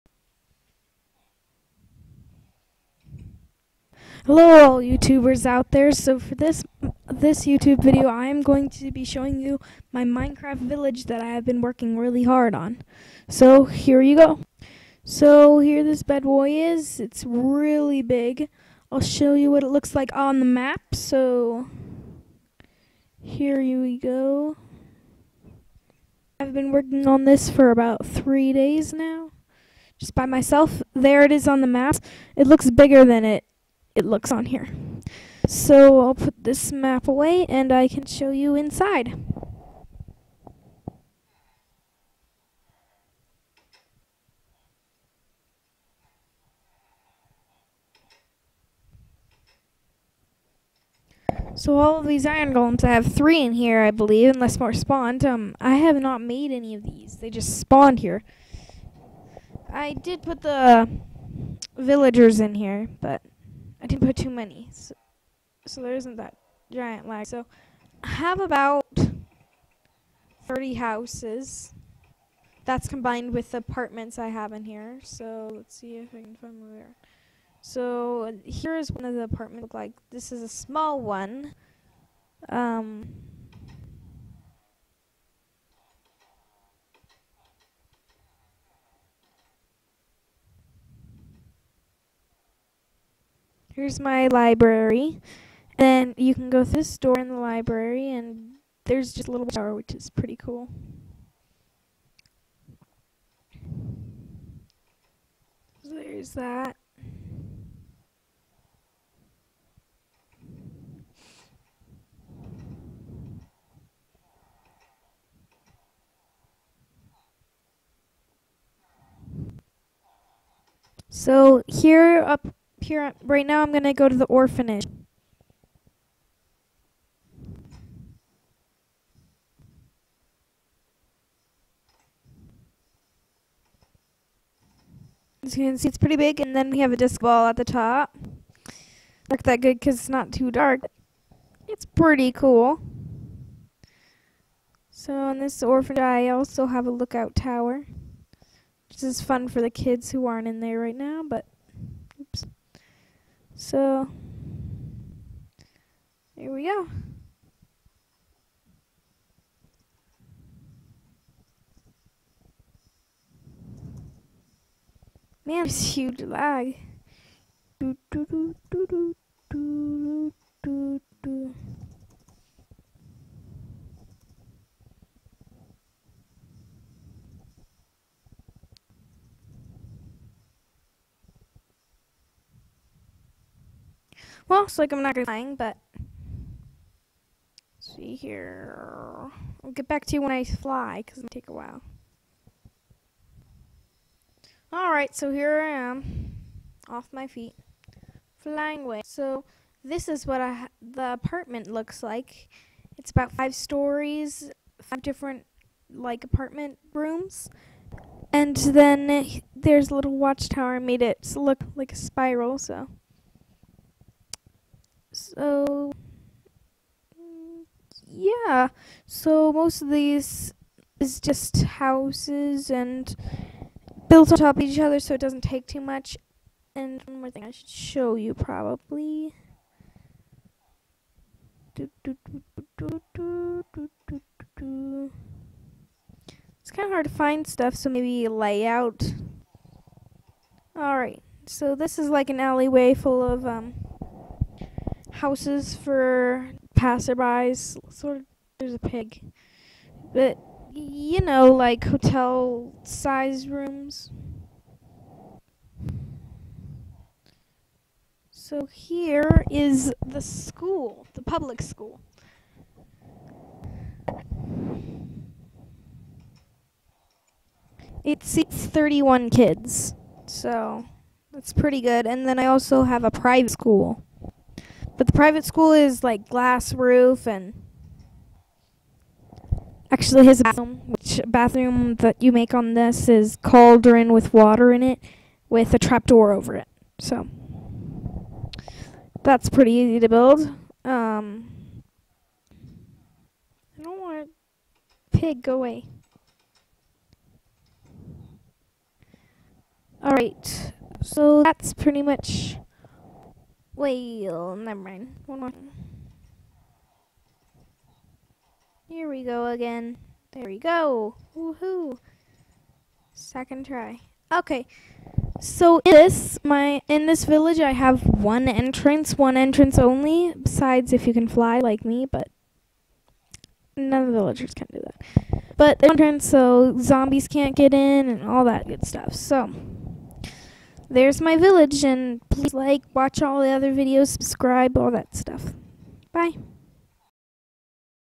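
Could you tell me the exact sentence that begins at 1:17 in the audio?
So here's one of the apartments look like.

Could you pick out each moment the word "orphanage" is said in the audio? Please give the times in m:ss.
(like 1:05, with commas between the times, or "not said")
2:04, 2:25.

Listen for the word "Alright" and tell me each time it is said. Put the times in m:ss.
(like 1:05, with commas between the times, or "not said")
3:14, 4:00.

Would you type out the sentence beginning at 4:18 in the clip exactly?
So here is the school, the public school.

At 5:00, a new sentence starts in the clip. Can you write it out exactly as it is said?
All right, so that's pretty much well, never mind.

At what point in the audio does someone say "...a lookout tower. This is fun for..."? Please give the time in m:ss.
2:26.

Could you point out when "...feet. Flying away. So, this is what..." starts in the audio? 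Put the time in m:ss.
3:17.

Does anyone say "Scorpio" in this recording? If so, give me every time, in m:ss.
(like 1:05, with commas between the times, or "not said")
not said.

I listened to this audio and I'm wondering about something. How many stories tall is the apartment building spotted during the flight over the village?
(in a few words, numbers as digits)
5.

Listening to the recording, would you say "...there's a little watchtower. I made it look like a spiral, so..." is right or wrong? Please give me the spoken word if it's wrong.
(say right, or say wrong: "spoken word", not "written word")
right.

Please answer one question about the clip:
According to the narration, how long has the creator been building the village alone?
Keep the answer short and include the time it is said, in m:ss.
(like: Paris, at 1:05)
3 days, at 0:27.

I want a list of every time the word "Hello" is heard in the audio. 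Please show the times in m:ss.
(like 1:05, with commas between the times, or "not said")
0:04.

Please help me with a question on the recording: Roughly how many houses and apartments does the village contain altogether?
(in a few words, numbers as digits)
30.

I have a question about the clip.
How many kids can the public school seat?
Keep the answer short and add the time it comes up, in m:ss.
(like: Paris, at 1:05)
31, at 4:28.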